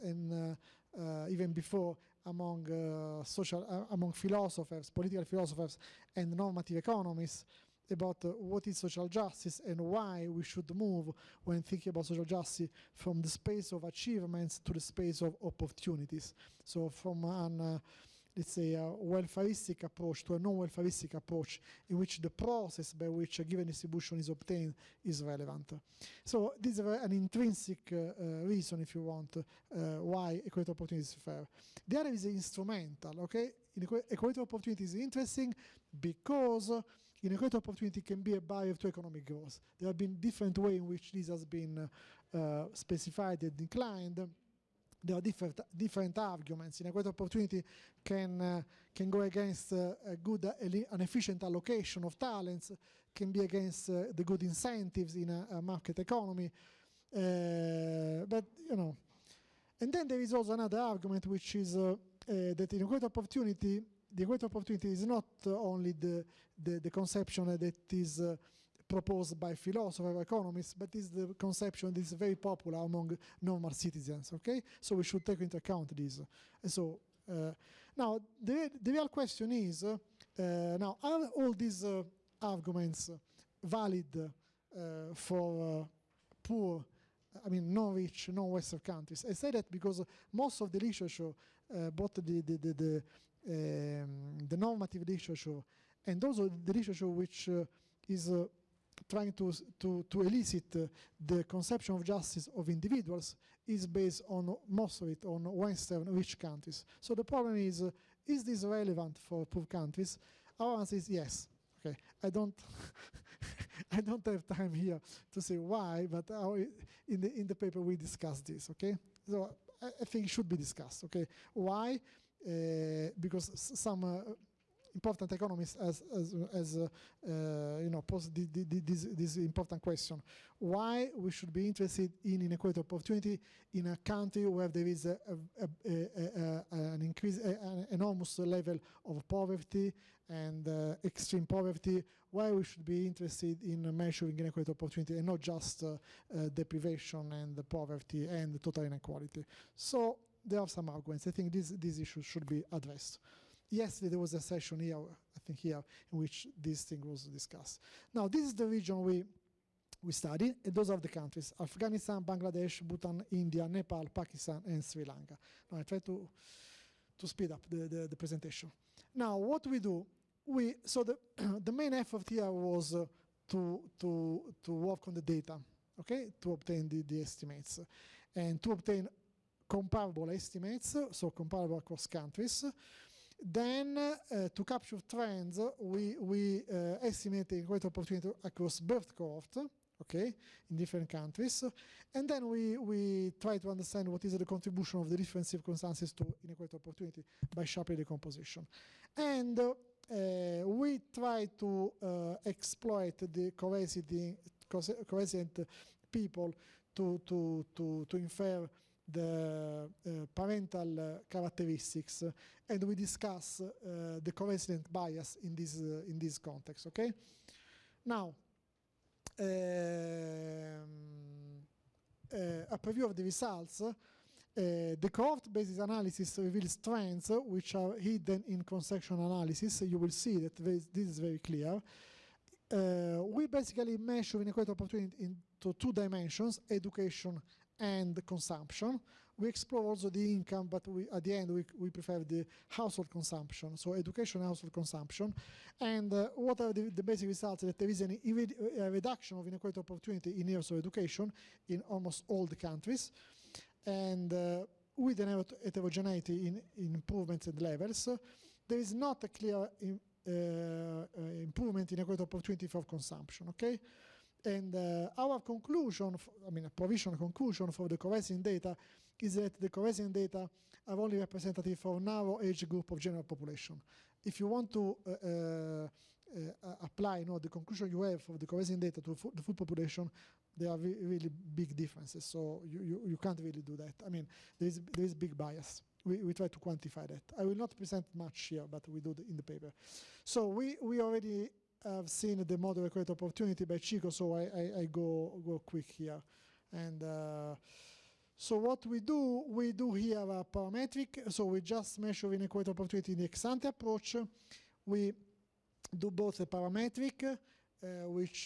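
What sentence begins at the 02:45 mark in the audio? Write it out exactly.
Now, I try to, to speed up the, the, the presentation.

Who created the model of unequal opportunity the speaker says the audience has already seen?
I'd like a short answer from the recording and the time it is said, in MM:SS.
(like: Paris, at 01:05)
Chico, at 04:53.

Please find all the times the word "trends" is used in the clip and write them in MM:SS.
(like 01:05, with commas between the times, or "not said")
03:05, 03:46.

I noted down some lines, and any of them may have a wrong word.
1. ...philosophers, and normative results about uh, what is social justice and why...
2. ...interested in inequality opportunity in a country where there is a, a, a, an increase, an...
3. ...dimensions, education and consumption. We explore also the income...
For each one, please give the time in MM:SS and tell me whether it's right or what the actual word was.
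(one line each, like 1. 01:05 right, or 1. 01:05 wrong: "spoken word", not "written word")
1. 00:05 wrong: "economists", not "results"
2. 02:11 right
3. 03:55 right.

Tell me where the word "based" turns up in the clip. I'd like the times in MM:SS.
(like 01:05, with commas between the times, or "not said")
01:43, 03:45.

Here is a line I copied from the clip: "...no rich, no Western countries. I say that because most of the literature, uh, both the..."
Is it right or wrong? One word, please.
right.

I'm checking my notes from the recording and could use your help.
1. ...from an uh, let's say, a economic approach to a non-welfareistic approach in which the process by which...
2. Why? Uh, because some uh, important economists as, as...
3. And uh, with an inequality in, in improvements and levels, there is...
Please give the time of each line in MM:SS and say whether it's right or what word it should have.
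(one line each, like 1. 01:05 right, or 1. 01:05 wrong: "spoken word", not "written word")
1. 00:16 wrong: "welfareistic", not "economic"
2. 02:01 right
3. 04:13 wrong: "heterogeneity", not "inequality".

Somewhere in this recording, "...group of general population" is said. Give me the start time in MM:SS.
04:32.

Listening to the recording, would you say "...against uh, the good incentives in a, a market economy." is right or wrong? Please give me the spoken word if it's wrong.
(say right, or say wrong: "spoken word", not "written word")
right.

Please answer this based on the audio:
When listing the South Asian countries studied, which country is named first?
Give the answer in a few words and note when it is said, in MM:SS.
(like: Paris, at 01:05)
Afghanistan, at 02:41.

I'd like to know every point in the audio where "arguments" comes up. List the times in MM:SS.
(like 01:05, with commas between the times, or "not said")
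00:46, 01:00, 01:22, 02:30.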